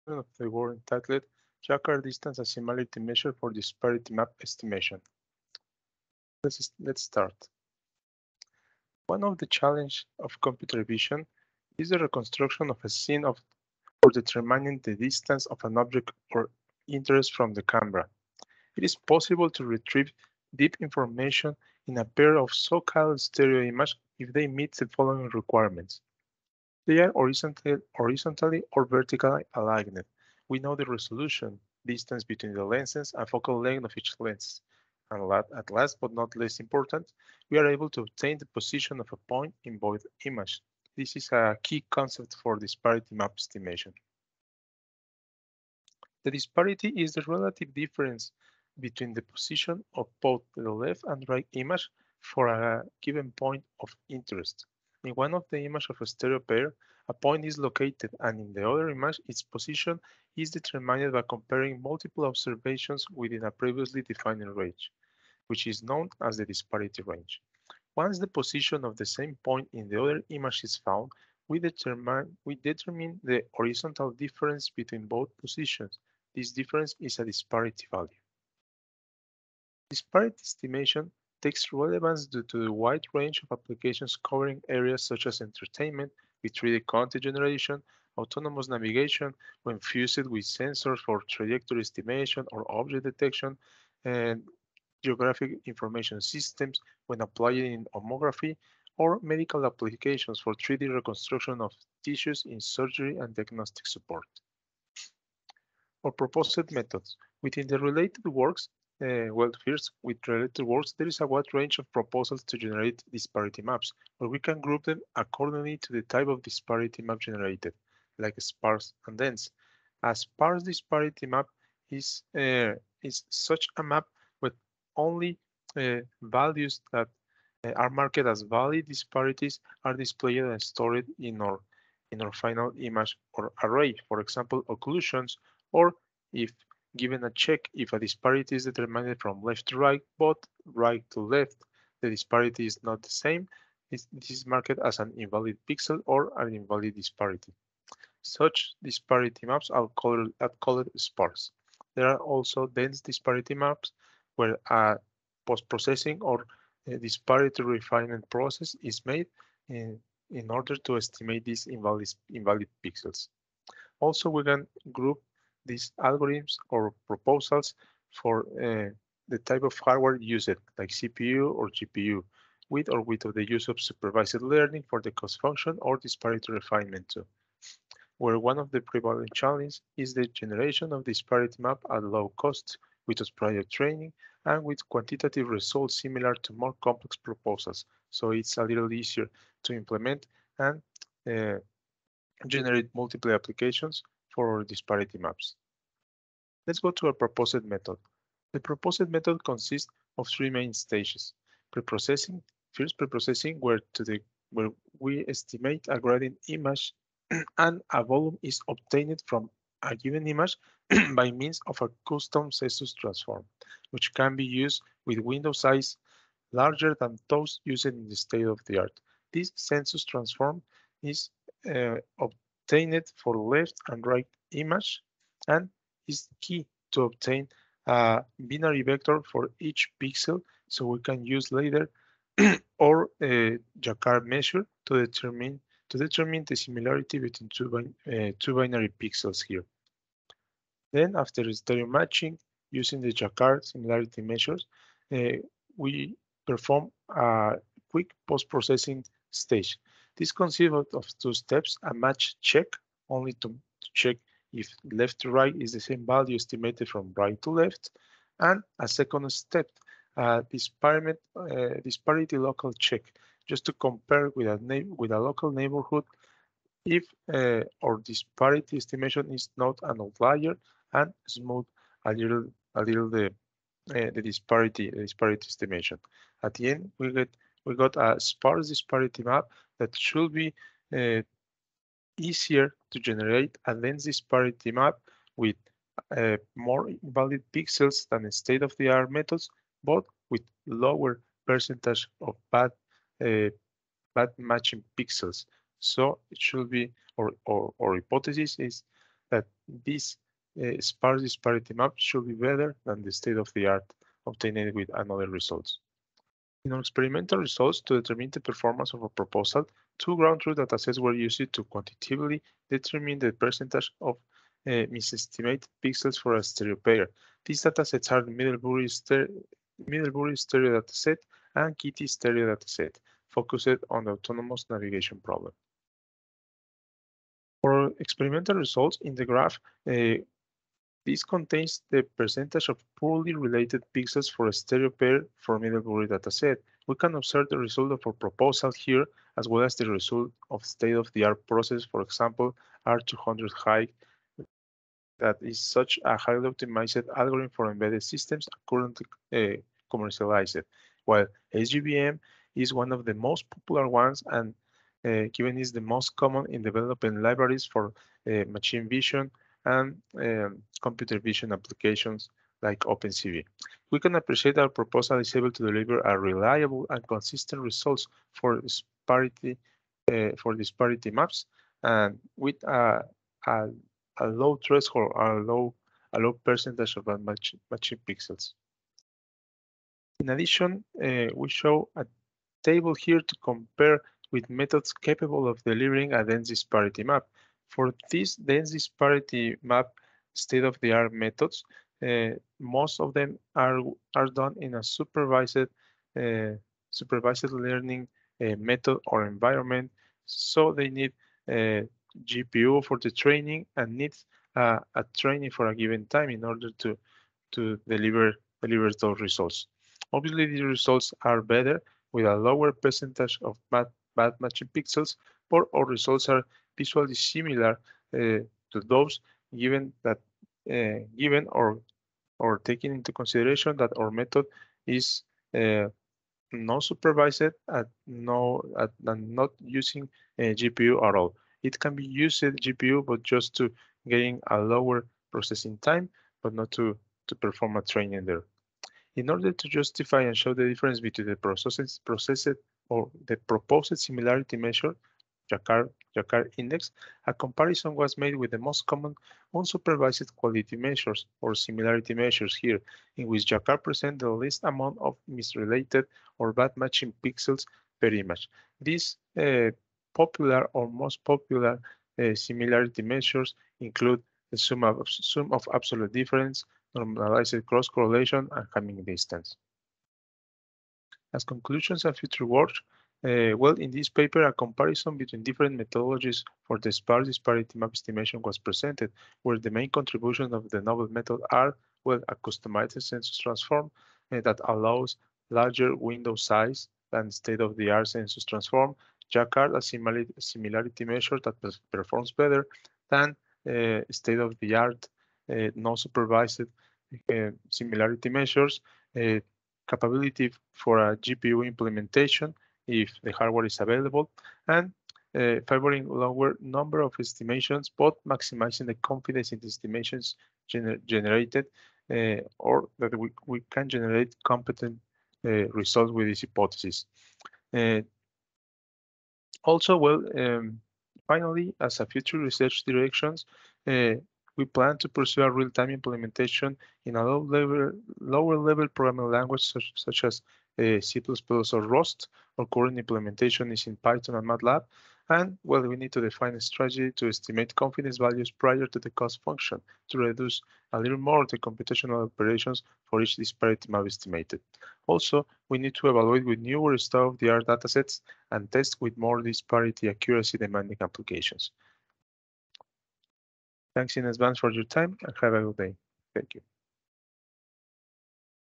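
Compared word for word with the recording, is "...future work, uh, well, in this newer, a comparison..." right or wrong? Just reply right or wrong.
wrong.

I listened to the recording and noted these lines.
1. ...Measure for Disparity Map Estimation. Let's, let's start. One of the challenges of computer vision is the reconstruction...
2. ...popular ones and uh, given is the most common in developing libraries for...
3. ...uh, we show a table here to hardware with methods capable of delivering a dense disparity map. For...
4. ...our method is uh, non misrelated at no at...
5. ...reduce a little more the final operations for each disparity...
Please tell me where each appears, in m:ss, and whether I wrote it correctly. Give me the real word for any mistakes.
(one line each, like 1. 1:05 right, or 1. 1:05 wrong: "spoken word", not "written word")
1. 0:02 right
2. 5:53 right
3. 6:21 wrong: "compare", not "hardware"
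4. 7:03 wrong: "supervised", not "misrelated"
5. 9:00 wrong: "computational", not "final".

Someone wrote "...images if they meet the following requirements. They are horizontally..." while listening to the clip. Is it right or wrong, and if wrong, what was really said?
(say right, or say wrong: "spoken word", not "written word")
right.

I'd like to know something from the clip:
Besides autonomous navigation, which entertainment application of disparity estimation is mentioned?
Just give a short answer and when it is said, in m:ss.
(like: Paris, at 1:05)
3D content generation, at 1:26.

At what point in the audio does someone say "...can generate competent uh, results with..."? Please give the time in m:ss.
8:33.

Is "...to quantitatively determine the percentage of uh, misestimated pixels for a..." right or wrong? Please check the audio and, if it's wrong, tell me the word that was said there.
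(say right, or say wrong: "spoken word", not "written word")
right.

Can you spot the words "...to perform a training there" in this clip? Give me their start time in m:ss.
7:17.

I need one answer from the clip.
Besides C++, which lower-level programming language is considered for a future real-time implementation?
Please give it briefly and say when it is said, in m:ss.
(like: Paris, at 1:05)
Rust, at 8:51.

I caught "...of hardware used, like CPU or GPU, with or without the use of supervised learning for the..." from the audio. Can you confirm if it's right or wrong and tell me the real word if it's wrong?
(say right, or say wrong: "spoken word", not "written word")
right.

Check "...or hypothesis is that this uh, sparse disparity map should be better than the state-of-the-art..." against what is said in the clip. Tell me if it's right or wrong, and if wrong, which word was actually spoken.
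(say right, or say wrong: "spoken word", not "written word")
right.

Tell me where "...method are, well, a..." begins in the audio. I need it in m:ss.
8:01.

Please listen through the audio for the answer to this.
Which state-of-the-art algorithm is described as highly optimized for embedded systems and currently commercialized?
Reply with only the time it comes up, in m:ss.
5:42.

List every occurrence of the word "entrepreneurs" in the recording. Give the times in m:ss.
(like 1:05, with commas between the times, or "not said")
not said.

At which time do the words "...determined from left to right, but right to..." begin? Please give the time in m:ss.
2:18.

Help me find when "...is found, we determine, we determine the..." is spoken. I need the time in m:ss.
1:10.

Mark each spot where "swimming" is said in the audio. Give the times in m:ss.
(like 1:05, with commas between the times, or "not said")
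not said.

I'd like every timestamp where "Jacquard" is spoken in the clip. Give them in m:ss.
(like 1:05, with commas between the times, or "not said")
3:53, 4:03.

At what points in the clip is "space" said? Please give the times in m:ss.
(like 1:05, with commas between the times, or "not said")
not said.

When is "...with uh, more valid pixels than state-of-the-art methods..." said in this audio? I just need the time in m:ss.
4:45.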